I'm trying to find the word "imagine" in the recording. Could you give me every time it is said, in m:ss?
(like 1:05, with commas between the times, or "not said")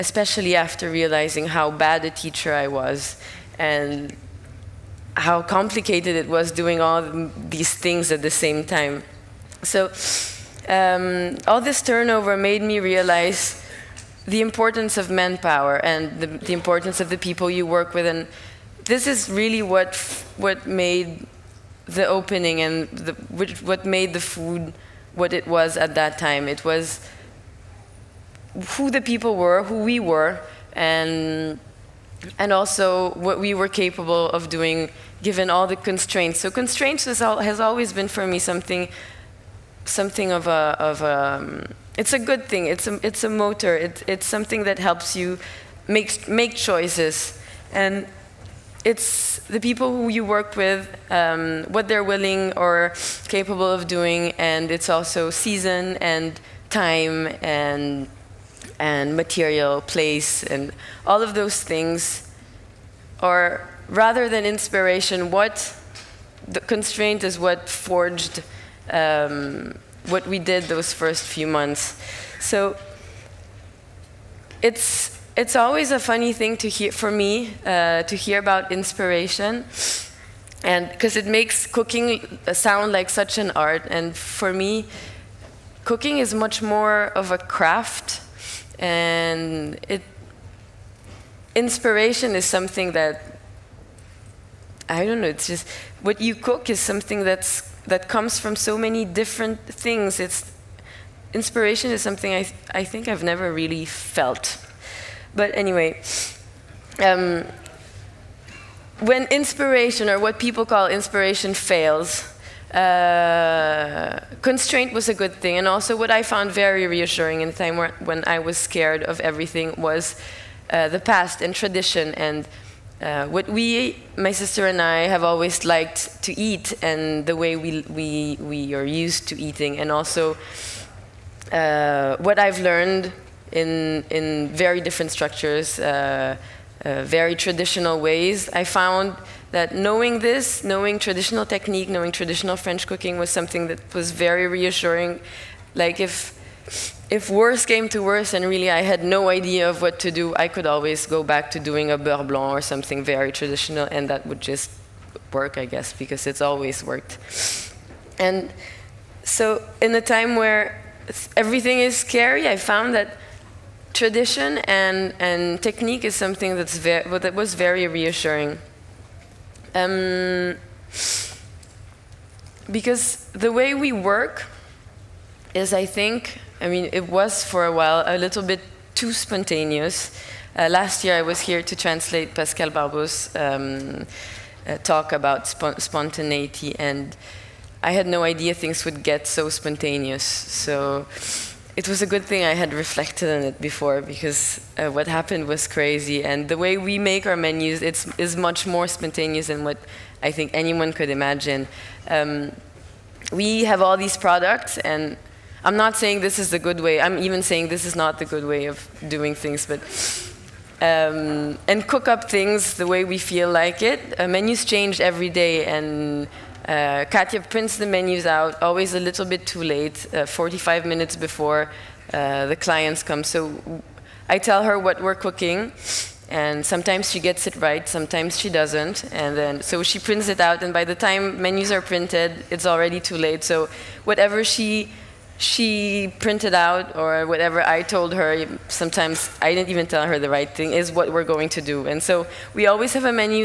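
3:21.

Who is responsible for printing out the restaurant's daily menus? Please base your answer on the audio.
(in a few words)
Katia.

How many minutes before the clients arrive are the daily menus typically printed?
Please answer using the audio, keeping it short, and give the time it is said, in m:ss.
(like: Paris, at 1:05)
45, at 3:40.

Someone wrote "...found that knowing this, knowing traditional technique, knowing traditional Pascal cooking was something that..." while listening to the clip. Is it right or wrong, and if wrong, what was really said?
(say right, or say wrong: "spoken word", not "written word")
wrong: "French", not "Pascal".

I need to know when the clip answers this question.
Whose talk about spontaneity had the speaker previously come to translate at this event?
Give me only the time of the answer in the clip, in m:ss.
3:02.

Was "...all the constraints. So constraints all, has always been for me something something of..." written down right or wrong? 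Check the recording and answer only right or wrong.
right.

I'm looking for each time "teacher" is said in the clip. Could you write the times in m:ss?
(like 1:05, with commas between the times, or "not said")
0:02.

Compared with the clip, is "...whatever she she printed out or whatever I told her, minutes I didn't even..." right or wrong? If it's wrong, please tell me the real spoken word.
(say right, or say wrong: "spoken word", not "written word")
wrong: "sometimes", not "minutes".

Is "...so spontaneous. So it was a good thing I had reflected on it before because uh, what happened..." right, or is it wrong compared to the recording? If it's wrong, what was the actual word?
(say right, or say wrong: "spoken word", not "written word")
right.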